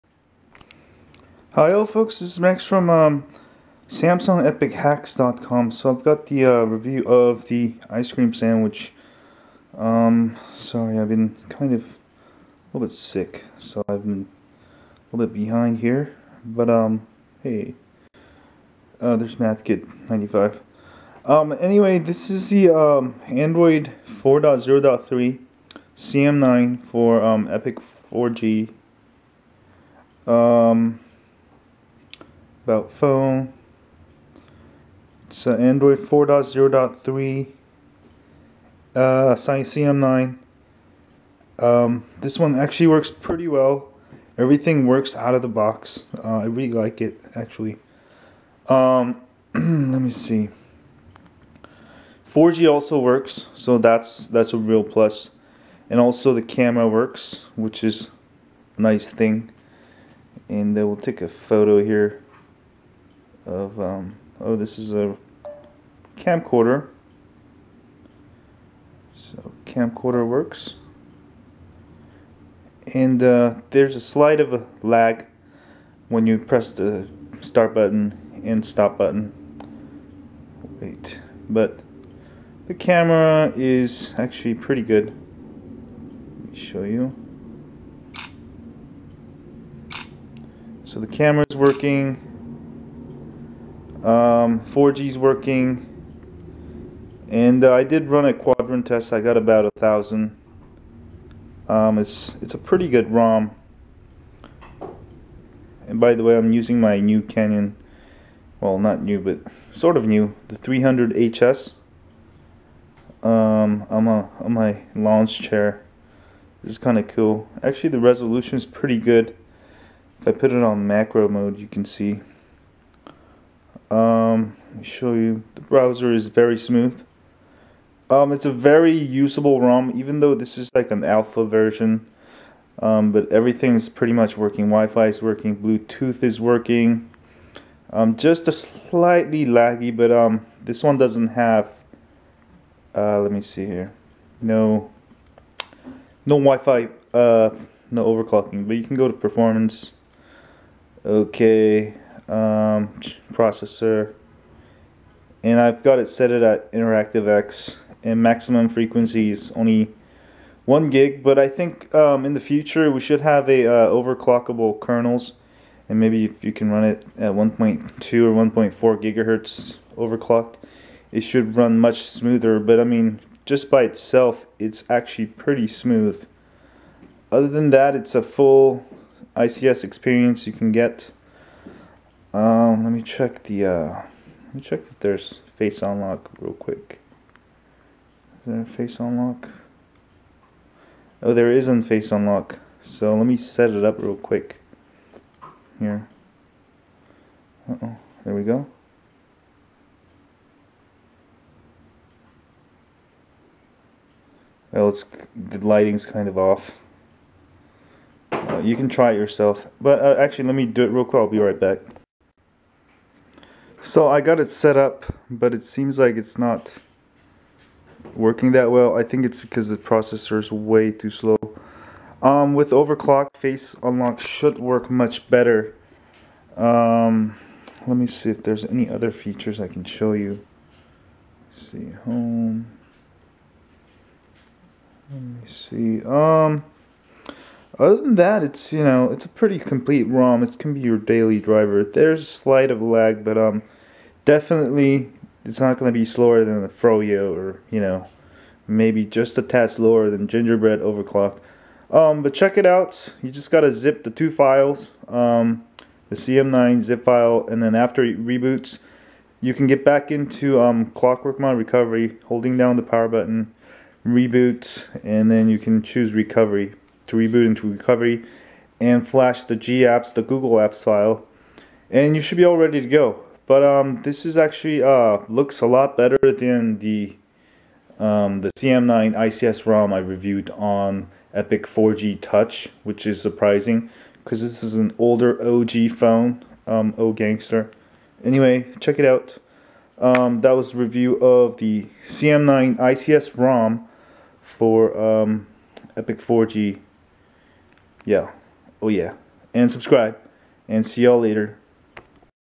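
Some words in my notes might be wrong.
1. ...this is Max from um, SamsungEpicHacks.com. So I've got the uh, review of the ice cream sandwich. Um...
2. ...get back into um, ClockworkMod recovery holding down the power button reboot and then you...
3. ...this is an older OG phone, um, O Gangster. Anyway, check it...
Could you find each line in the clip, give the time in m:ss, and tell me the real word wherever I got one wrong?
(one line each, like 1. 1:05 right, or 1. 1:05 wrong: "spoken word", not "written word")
1. 0:02 right
2. 4:19 right
3. 4:44 right.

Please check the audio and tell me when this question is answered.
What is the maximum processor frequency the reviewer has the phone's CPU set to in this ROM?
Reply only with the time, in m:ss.
2:39.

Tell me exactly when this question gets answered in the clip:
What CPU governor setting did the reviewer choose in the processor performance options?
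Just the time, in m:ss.
2:36.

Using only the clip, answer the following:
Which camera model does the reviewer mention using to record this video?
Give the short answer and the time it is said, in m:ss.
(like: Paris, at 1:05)
Canon 300 HS, at 1:50.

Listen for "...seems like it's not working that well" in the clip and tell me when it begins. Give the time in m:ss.
3:35.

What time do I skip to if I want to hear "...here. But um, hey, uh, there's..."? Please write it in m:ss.
0:15.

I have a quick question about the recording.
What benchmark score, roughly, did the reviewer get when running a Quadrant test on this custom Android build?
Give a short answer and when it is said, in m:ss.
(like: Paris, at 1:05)
about 1000, at 1:39.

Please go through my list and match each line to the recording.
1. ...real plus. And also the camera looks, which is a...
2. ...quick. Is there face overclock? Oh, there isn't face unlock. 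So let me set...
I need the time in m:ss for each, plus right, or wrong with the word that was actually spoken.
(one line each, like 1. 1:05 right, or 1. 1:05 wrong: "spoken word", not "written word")
1. 0:54 wrong: "works", not "looks"
2. 3:06 wrong: "unlock", not "overclock".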